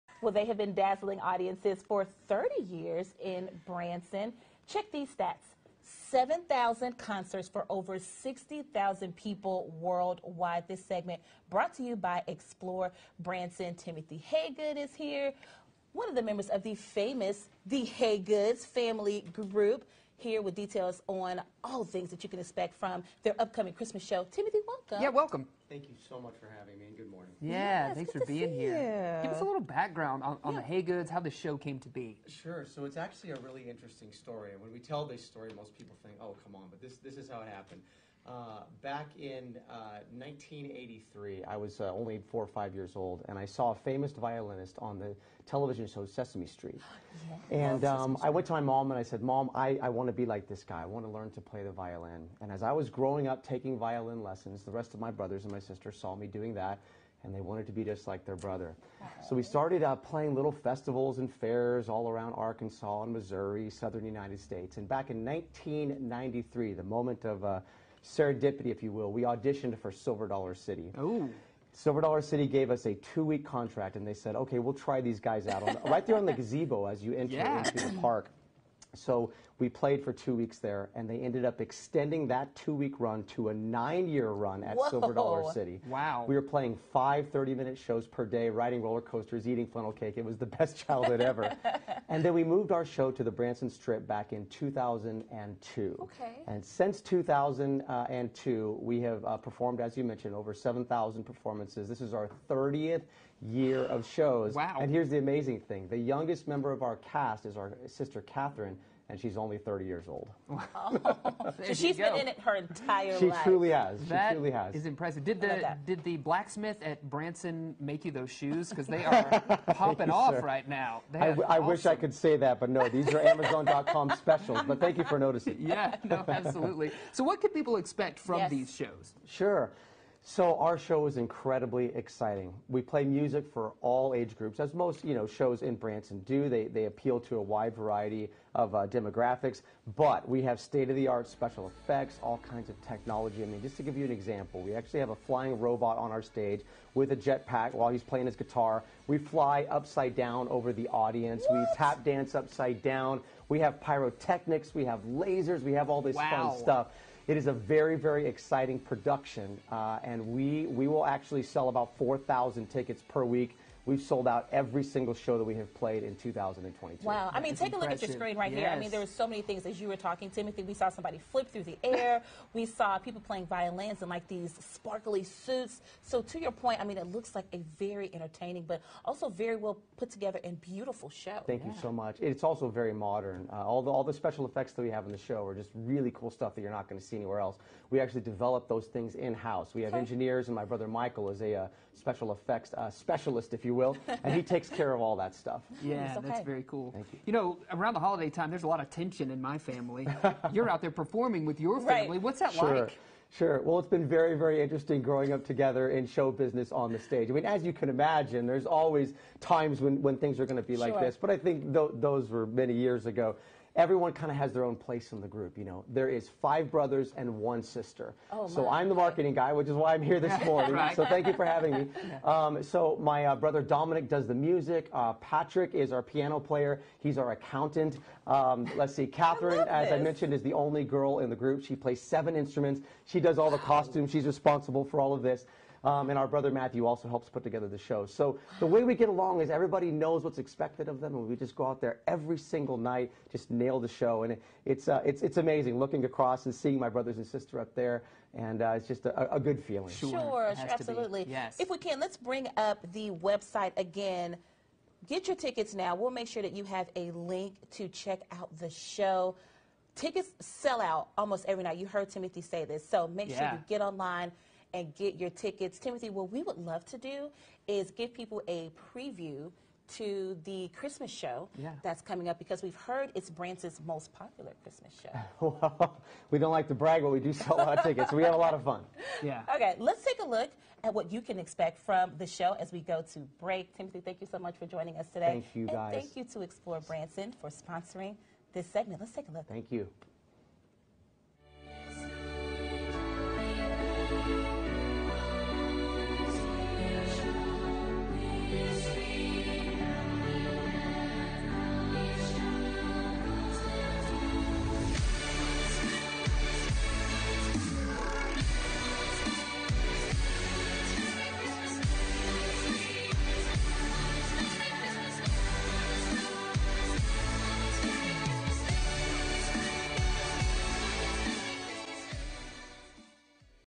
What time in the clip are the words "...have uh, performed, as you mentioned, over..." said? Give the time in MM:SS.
01:39.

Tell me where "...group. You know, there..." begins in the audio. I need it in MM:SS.
03:35.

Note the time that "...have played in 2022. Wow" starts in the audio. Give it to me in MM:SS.
02:45.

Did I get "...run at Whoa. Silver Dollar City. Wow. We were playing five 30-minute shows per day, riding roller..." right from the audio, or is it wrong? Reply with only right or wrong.
right.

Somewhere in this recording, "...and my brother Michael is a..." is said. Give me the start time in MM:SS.
03:10.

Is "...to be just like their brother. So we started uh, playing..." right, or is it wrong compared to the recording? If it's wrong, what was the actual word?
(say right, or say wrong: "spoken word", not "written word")
right.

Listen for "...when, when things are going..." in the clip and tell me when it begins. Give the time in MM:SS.
03:29.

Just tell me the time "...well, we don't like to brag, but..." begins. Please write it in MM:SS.
04:35.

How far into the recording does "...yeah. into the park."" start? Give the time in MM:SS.
01:17.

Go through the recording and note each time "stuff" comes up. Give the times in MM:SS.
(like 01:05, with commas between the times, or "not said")
02:36, 03:06, 03:15.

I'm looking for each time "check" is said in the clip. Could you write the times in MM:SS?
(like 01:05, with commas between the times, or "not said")
00:04, 04:17.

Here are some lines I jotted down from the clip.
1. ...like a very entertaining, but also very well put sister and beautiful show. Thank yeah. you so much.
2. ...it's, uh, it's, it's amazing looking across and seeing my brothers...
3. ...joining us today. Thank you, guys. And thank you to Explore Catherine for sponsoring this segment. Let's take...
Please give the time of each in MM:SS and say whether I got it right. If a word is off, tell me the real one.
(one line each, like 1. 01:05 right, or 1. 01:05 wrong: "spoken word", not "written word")
1. 02:57 wrong: "together", not "sister"
2. 04:04 right
3. 04:44 wrong: "Branson", not "Catherine".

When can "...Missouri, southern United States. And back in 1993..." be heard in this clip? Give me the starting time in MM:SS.
01:03.